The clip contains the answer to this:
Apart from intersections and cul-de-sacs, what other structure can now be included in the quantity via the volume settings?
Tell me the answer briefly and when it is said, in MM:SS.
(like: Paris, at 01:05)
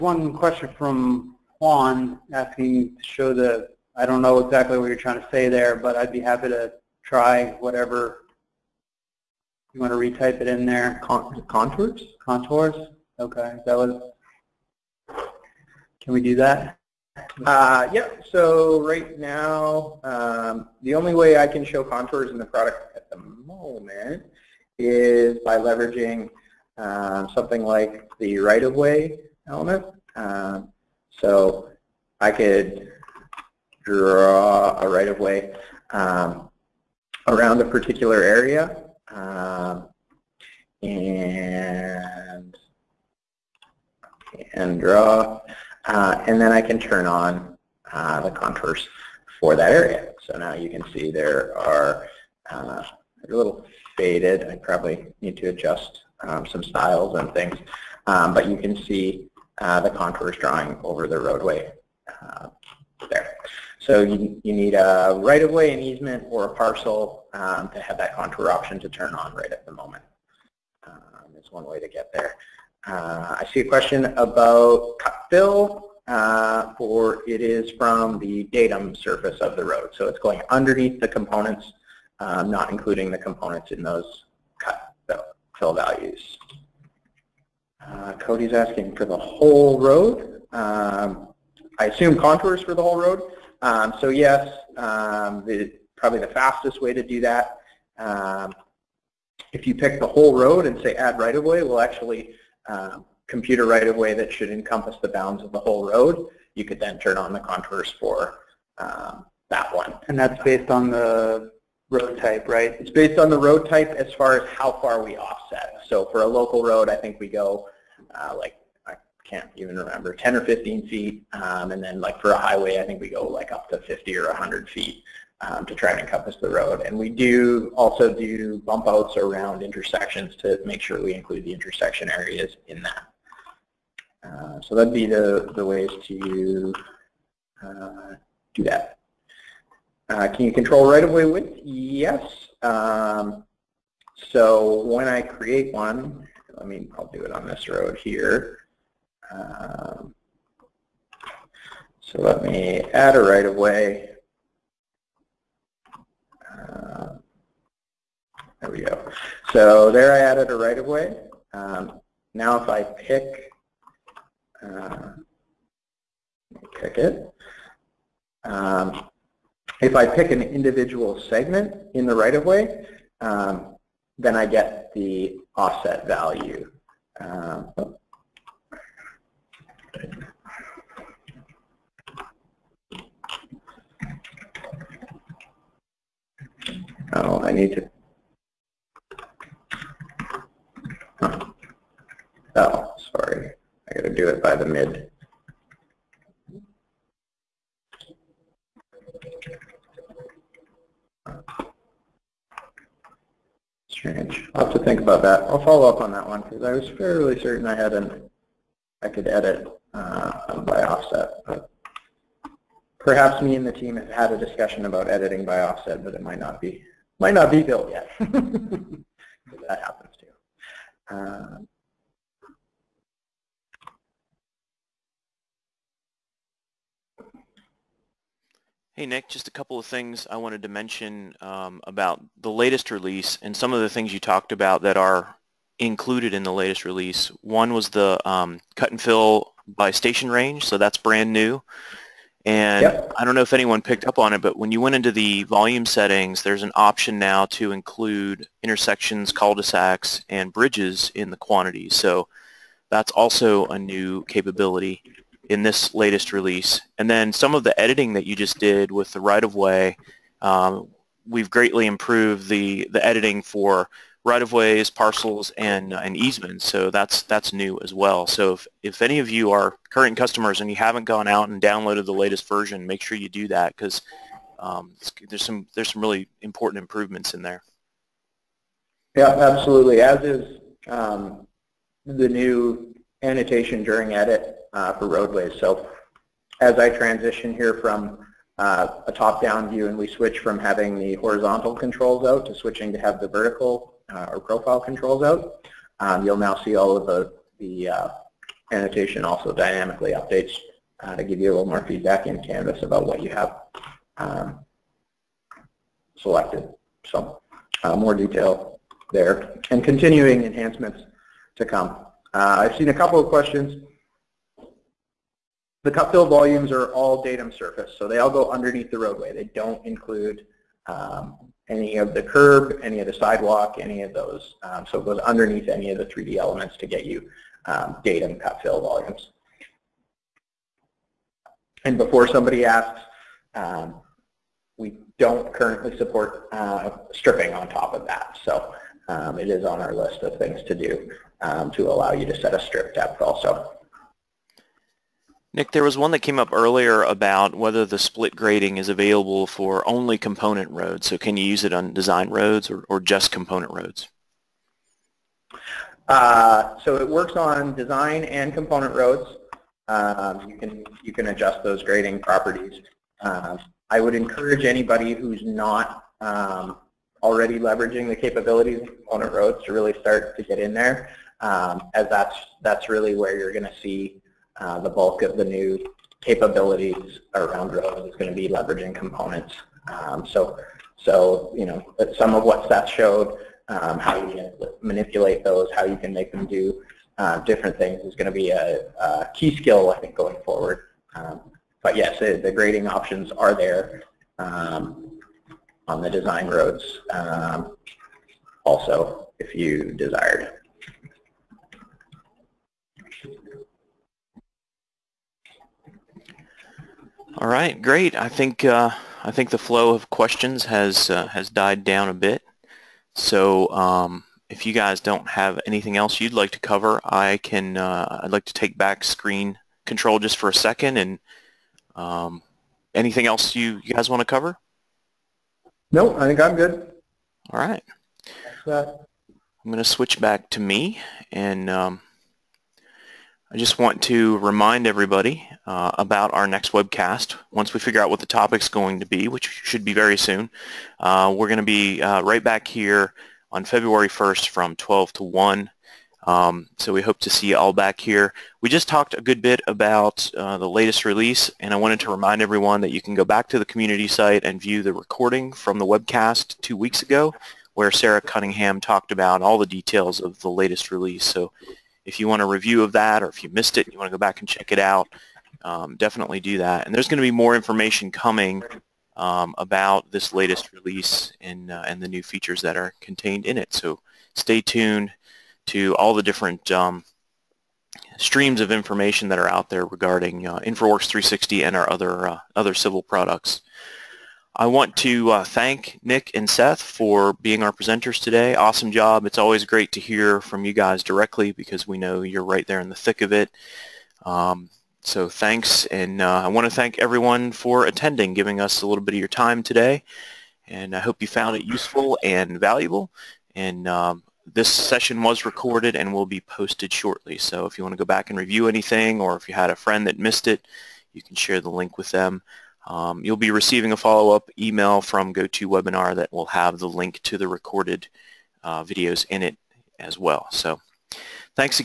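bridges, at 04:10.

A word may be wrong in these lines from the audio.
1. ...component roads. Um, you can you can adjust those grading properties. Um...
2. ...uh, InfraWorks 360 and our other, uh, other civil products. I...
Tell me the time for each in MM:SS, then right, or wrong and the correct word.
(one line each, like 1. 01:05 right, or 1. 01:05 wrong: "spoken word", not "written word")
1. 05:58 right
2. 08:00 right.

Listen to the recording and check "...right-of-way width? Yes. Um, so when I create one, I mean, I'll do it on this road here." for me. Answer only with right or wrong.
right.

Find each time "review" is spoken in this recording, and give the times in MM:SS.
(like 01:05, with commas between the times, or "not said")
07:42, 08:28.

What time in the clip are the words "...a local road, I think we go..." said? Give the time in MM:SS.
01:56.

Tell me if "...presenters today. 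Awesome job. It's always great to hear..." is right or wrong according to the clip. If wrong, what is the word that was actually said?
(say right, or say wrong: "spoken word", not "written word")
right.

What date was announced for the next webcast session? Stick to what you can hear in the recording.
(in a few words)
February 1st.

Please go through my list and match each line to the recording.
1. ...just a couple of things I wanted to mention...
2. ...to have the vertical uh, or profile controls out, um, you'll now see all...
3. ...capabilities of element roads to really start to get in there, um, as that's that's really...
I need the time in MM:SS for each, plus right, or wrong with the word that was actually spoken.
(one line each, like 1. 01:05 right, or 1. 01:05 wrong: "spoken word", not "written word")
1. 03:49 right
2. 04:52 right
3. 06:08 wrong: "component", not "element".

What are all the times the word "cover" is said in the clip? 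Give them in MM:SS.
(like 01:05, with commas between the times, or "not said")
06:56, 07:04.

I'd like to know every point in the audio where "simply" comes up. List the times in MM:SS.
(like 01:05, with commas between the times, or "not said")
not said.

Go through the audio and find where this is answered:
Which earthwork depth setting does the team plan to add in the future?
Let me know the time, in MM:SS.
05:42.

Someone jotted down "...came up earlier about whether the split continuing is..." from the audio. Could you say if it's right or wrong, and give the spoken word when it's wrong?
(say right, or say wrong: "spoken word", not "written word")
wrong: "grading", not "continuing".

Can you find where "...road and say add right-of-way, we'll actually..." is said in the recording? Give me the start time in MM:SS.
01:40.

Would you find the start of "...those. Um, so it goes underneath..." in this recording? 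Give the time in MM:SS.
05:24.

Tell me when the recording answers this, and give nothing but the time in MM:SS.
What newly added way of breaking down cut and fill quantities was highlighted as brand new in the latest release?
03:59.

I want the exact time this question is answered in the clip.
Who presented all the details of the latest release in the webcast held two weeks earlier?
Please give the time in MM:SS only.
07:37.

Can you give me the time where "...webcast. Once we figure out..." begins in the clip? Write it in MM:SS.
07:16.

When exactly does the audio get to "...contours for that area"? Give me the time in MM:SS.
00:48.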